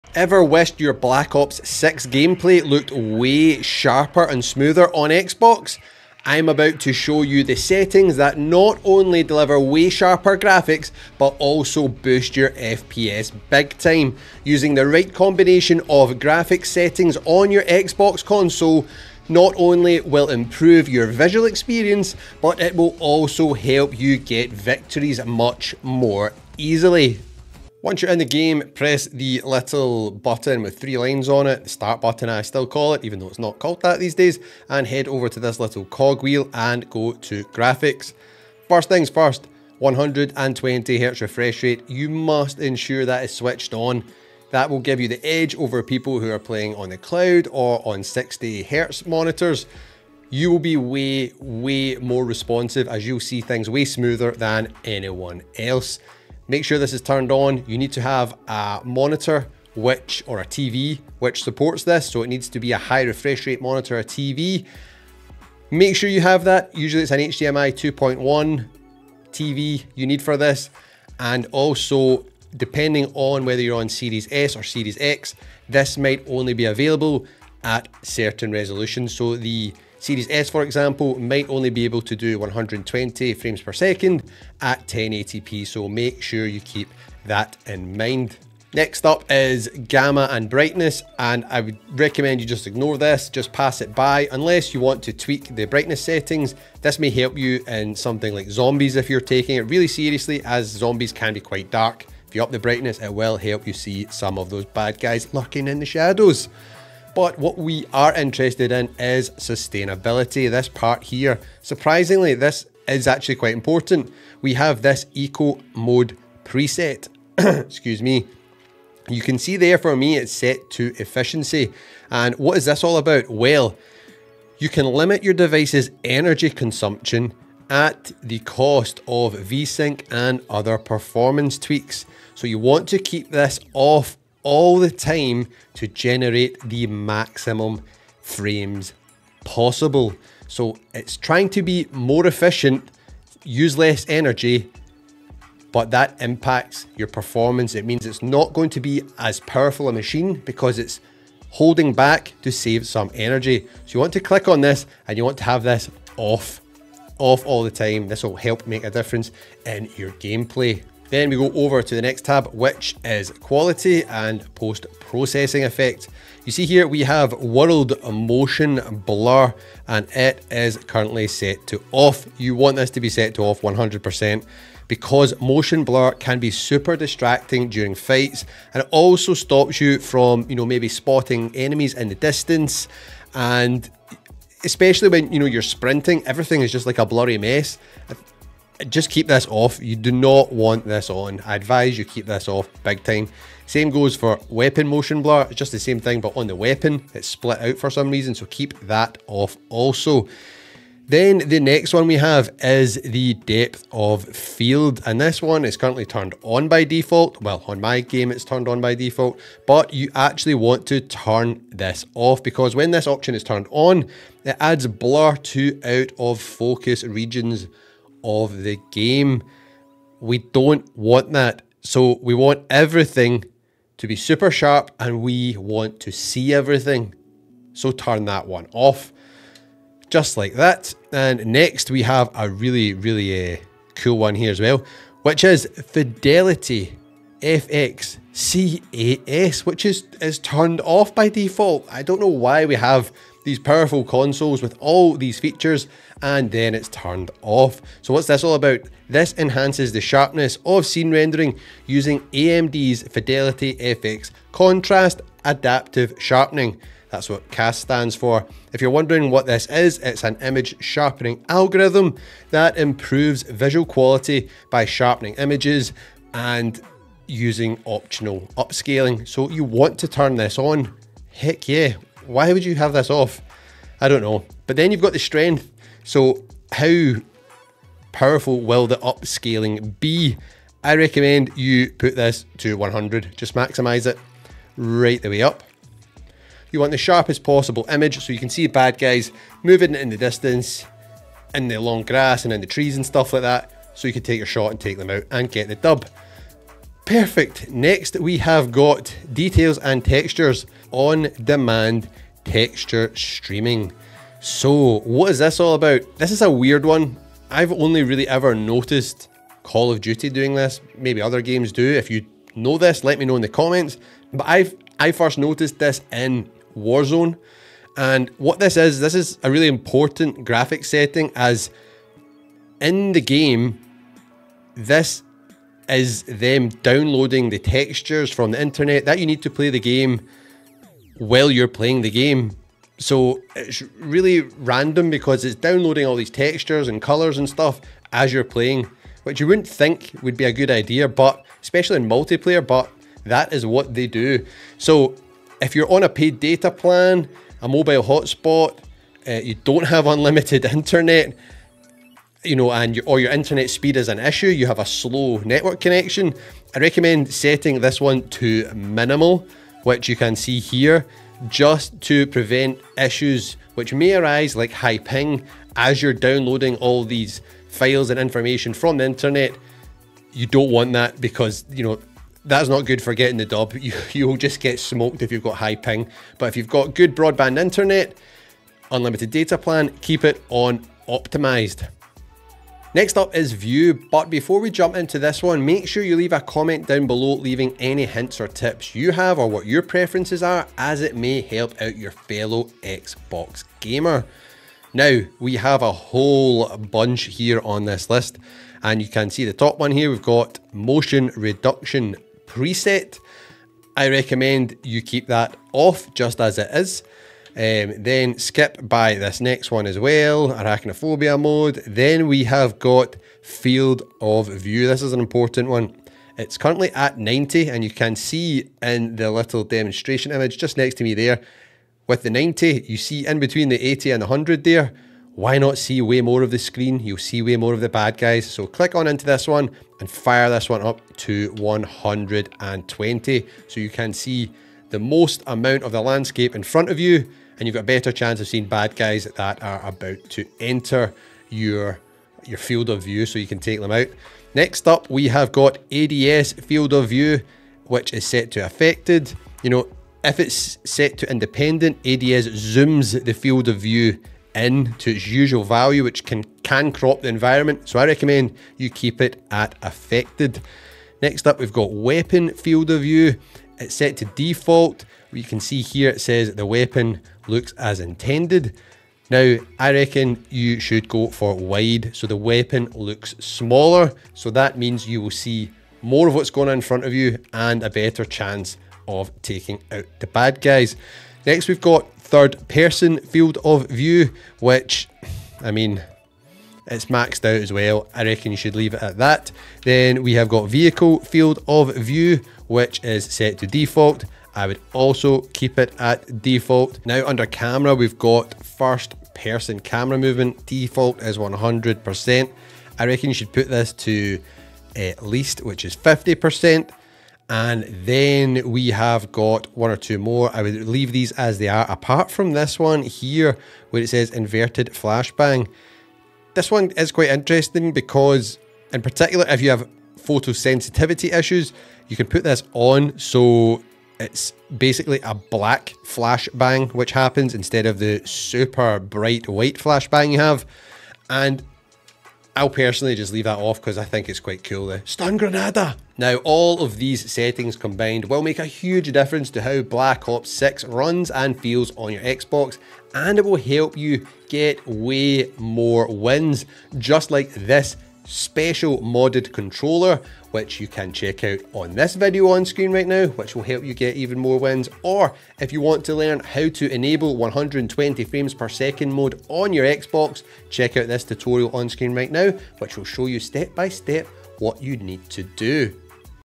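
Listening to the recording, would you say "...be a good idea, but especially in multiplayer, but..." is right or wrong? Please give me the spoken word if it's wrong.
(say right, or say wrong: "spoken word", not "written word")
right.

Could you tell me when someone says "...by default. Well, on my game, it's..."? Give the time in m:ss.
3:26.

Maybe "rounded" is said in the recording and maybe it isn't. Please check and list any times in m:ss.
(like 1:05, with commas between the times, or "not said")
not said.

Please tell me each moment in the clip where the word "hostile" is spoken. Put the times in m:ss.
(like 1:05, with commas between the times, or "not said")
not said.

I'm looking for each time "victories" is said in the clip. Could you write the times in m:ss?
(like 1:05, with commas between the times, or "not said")
0:24.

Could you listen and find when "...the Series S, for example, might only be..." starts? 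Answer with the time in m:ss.
1:19.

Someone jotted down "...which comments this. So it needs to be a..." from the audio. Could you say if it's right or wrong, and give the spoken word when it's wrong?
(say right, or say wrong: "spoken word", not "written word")
wrong: "supports", not "comments".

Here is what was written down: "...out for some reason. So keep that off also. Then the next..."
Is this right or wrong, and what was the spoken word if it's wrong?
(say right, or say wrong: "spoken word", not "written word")
right.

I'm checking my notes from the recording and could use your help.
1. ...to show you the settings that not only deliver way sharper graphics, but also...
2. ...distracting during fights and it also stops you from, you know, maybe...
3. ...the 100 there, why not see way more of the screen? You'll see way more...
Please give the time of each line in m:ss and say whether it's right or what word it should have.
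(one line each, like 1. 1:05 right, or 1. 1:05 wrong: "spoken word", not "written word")
1. 0:06 right
2. 2:56 right
3. 7:04 right.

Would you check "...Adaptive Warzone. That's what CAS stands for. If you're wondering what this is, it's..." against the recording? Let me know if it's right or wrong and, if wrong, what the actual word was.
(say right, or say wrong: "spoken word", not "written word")
wrong: "Sharpening", not "Warzone".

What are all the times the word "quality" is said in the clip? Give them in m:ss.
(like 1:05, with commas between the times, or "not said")
2:43, 4:23.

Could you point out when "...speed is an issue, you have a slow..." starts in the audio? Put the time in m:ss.
5:53.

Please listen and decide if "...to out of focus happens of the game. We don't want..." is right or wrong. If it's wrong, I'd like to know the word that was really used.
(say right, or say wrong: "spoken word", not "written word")
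wrong: "regions", not "happens".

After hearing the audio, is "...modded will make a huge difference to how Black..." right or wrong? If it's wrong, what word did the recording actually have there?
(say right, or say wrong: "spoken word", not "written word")
wrong: "combined", not "modded".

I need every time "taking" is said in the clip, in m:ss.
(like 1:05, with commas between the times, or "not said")
1:39, 7:59.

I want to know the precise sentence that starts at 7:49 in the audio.
Now, I reckon you should go for wide so the weapon looks smaller.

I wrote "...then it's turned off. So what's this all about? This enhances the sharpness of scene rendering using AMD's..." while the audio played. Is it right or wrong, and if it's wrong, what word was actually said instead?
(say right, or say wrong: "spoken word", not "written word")
right.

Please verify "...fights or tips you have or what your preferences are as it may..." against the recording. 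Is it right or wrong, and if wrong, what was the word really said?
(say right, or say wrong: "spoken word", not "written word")
wrong: "hints", not "fights".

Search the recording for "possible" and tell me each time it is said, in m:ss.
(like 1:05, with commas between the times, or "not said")
2:19, 4:47.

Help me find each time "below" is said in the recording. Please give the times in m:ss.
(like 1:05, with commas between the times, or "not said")
6:27.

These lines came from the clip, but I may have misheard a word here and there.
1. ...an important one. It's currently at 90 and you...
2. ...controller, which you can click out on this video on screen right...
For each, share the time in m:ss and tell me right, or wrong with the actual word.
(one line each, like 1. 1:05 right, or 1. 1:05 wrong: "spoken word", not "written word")
1. 6:55 right
2. 9:09 wrong: "check", not "click".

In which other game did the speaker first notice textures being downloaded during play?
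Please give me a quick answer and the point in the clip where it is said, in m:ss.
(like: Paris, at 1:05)
Warzone, at 5:16.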